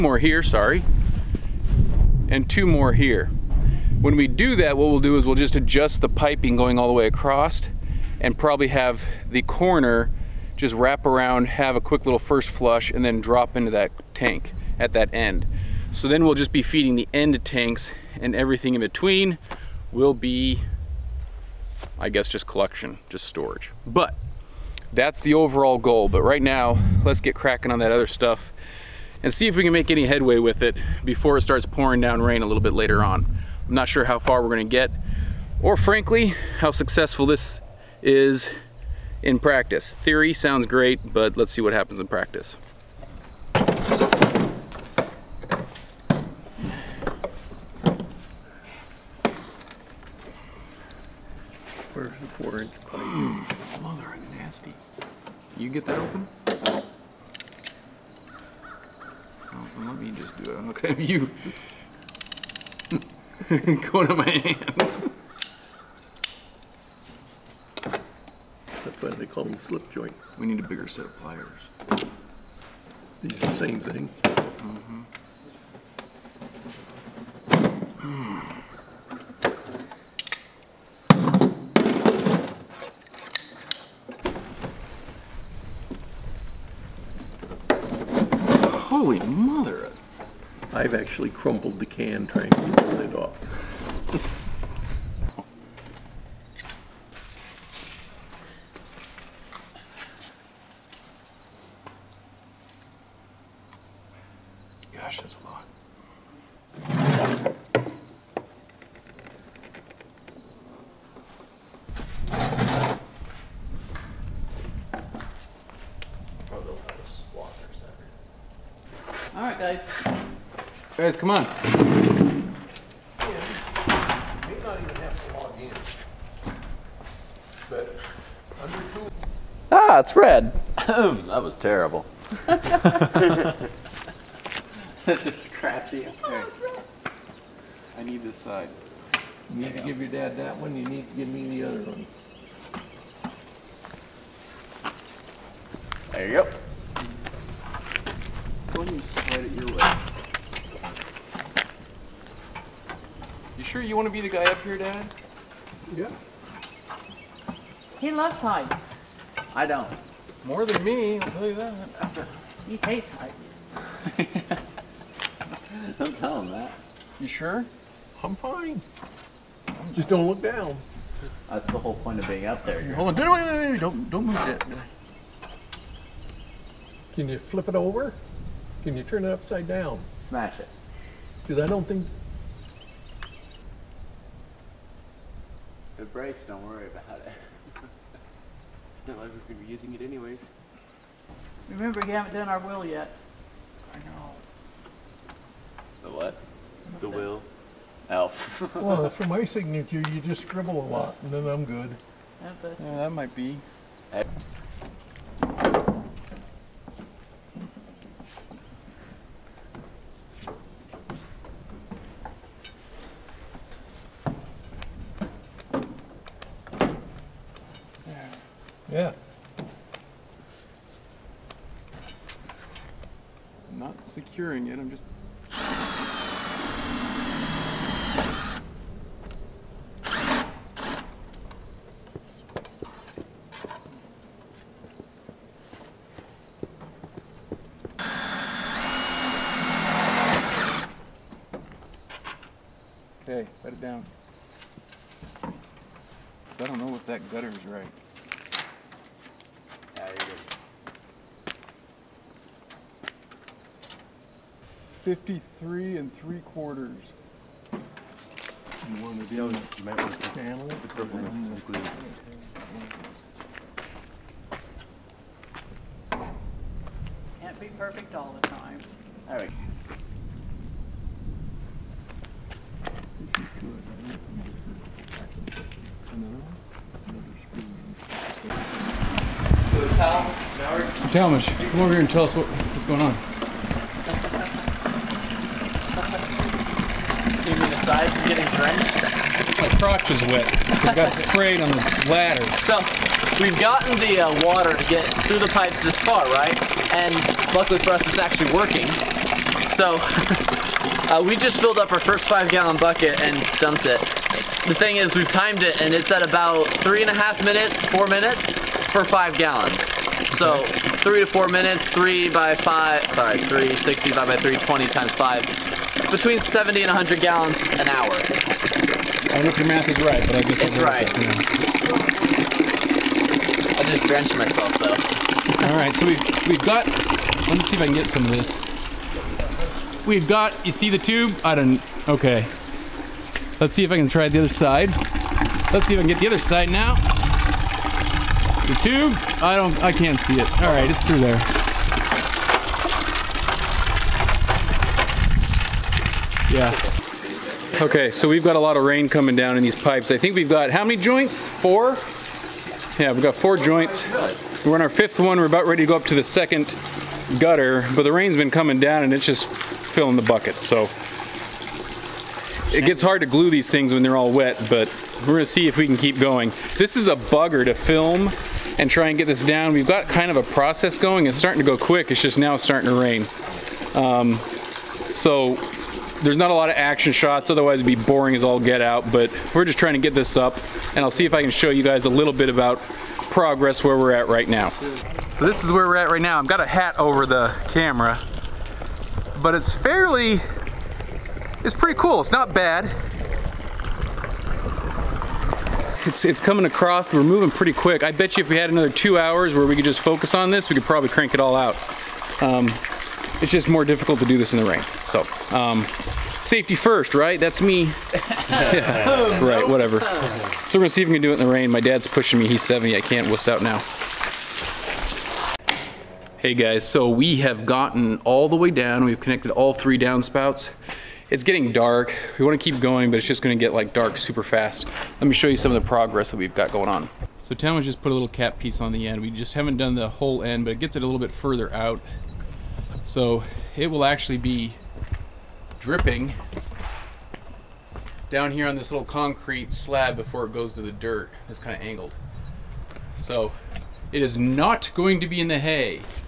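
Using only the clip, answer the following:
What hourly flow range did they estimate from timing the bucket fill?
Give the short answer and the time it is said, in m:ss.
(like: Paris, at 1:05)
70 to 100 gallons, at 5:16.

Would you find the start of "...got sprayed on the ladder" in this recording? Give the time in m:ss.
4:50.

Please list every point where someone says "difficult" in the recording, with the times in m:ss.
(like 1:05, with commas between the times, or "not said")
6:43.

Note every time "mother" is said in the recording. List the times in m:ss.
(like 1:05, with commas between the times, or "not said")
0:53, 1:29.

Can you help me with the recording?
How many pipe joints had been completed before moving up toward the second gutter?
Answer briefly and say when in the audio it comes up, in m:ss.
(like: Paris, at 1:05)
4, at 5:53.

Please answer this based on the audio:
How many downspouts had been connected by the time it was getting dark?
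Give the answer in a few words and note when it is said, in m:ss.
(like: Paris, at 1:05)
3, at 6:59.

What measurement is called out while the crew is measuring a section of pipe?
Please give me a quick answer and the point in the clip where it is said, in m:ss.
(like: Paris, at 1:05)
53 and 3/4, at 4:15.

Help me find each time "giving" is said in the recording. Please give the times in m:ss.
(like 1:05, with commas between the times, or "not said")
not said.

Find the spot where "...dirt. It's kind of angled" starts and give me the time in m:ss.
7:20.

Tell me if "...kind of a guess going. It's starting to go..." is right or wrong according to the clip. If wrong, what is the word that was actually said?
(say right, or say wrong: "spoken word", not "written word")
wrong: "process", not "guess".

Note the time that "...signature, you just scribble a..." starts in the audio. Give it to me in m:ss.
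3:19.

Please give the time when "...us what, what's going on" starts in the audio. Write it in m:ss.
4:42.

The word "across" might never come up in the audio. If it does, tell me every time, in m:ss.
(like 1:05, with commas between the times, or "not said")
0:07, 6:36.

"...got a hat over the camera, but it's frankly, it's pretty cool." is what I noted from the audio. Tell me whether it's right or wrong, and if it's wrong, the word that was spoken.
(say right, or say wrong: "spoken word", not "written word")
wrong: "fairly", not "frankly".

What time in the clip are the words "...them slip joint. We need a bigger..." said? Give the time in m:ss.
1:09.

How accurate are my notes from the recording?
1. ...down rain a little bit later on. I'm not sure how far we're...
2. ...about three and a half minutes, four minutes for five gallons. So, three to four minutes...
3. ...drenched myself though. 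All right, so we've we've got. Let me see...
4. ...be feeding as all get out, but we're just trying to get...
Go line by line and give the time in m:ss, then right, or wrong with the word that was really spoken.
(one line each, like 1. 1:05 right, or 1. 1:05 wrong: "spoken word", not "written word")
1. 0:32 right
2. 5:06 right
3. 5:24 right
4. 6:17 wrong: "boring", not "feeding".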